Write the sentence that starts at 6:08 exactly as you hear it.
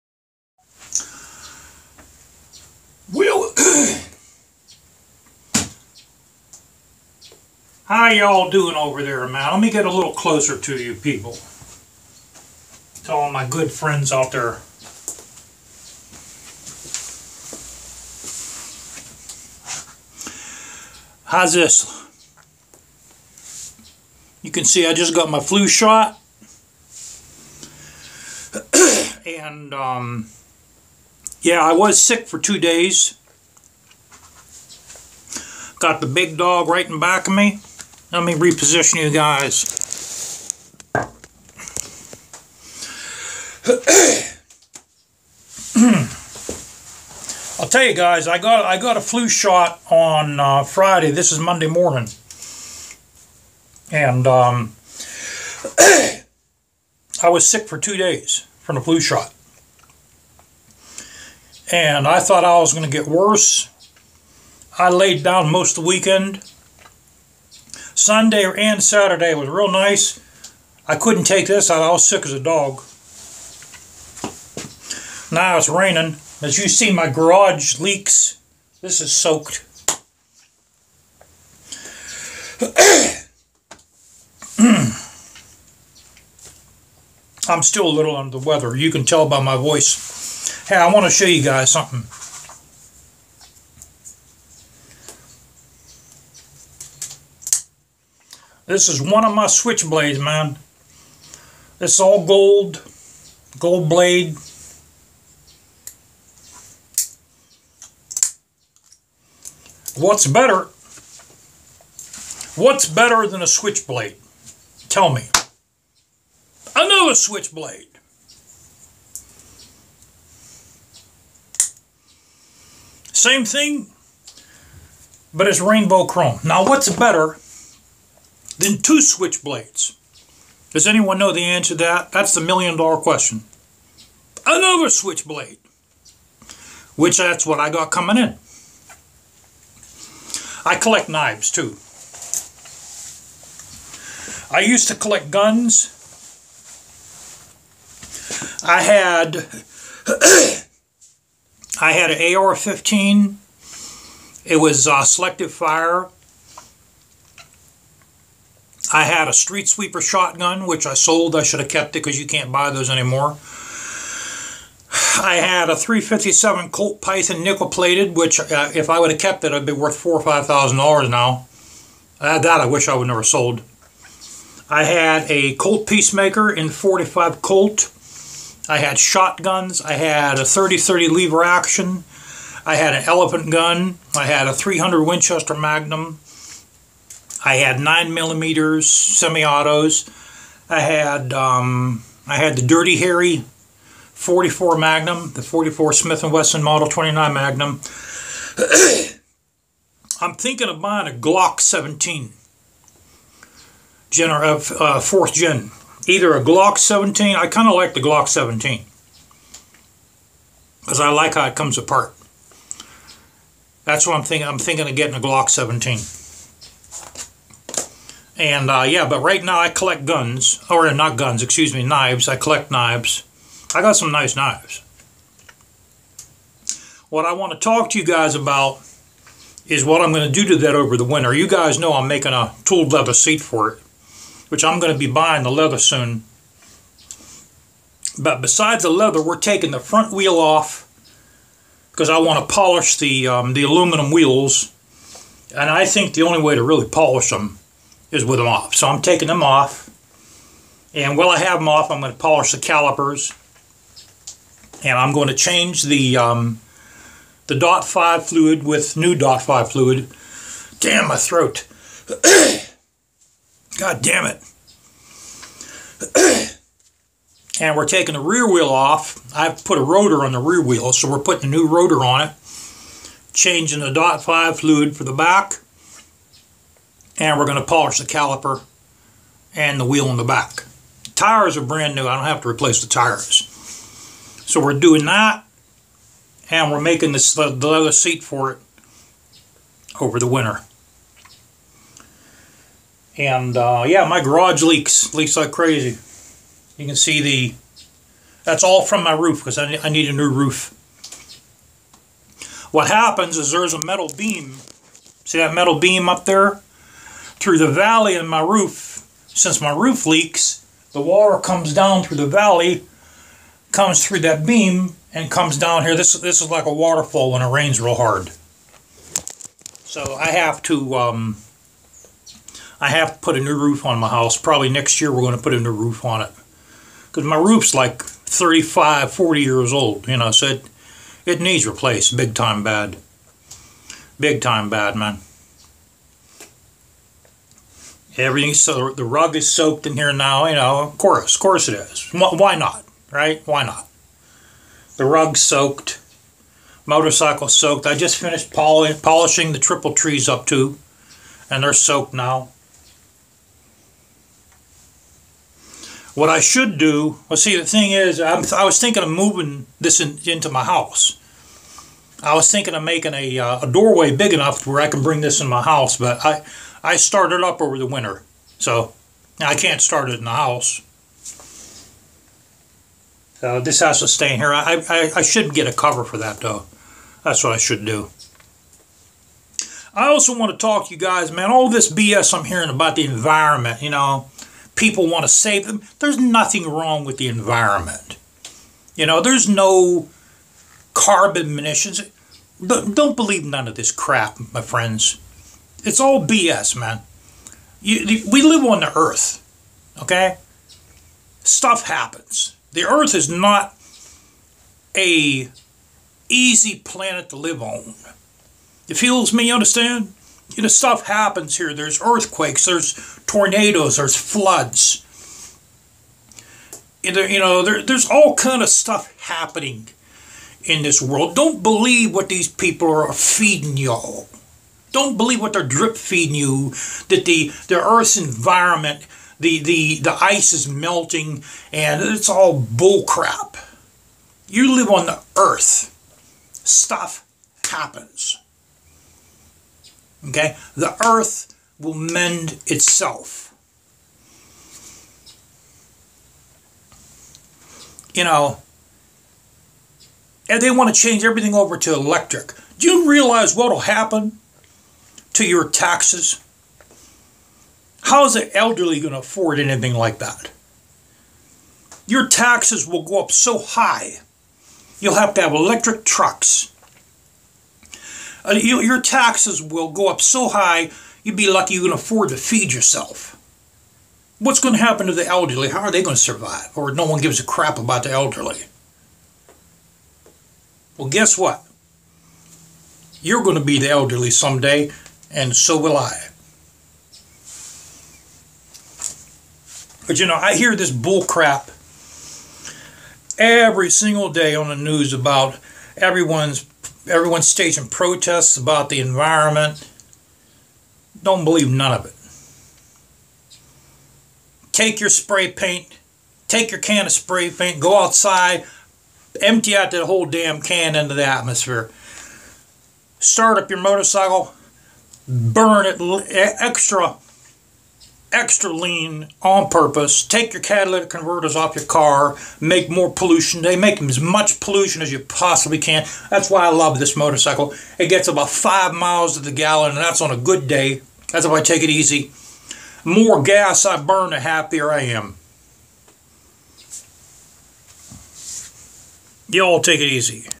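So I can't start it in the house.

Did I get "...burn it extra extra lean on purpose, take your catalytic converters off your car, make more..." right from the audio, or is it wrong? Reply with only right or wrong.
right.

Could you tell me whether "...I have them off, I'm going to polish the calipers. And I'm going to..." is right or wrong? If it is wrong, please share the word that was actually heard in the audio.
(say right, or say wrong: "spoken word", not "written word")
right.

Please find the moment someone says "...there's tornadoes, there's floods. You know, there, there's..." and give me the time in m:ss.
6:52.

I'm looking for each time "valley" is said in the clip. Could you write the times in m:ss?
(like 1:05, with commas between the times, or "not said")
5:07, 5:12.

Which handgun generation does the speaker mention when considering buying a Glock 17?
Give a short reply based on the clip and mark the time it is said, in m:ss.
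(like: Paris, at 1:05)
fourth gen, at 3:24.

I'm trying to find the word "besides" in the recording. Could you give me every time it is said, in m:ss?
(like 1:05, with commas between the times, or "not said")
3:58.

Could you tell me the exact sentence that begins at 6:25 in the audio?
There's nothing wrong with the environment.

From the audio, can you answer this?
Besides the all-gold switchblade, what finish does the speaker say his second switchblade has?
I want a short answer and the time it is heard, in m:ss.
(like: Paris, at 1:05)
rainbow chrome, at 2:05.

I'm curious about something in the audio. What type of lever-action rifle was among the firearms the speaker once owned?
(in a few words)
30-30.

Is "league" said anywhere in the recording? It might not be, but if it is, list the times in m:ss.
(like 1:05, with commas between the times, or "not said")
not said.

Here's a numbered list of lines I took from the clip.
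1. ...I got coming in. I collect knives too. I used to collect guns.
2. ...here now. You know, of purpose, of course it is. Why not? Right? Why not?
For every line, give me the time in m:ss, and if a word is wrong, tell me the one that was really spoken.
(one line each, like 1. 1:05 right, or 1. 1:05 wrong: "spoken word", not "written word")
1. 2:17 right
2. 5:39 wrong: "course", not "purpose".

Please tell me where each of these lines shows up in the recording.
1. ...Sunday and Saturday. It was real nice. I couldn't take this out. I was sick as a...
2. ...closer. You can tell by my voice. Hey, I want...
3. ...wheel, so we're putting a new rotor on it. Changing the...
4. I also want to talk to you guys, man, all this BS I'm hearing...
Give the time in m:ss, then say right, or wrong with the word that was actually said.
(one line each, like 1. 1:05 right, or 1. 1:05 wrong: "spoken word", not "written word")
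1. 1:08 right
2. 1:28 wrong: "weather", not "closer"
3. 4:30 right
4. 6:19 right.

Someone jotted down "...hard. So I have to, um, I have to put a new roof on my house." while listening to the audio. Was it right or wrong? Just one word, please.
right.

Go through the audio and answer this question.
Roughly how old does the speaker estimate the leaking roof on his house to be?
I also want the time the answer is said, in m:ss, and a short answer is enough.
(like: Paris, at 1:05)
35 to 40 years, at 5:28.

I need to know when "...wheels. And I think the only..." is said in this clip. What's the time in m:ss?
4:04.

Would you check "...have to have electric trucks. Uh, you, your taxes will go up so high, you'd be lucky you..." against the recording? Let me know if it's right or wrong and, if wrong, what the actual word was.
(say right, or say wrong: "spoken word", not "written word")
right.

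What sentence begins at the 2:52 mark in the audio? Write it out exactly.
Uh, that I wish I would never sold.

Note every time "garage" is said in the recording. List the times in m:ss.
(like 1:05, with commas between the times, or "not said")
1:17, 4:54.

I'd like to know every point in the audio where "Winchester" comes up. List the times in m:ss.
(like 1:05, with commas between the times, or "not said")
3:05.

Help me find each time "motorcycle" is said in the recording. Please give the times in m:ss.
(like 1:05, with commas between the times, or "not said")
5:46, 8:33, 8:47.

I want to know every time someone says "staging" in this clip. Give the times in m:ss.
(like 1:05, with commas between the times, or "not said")
8:17.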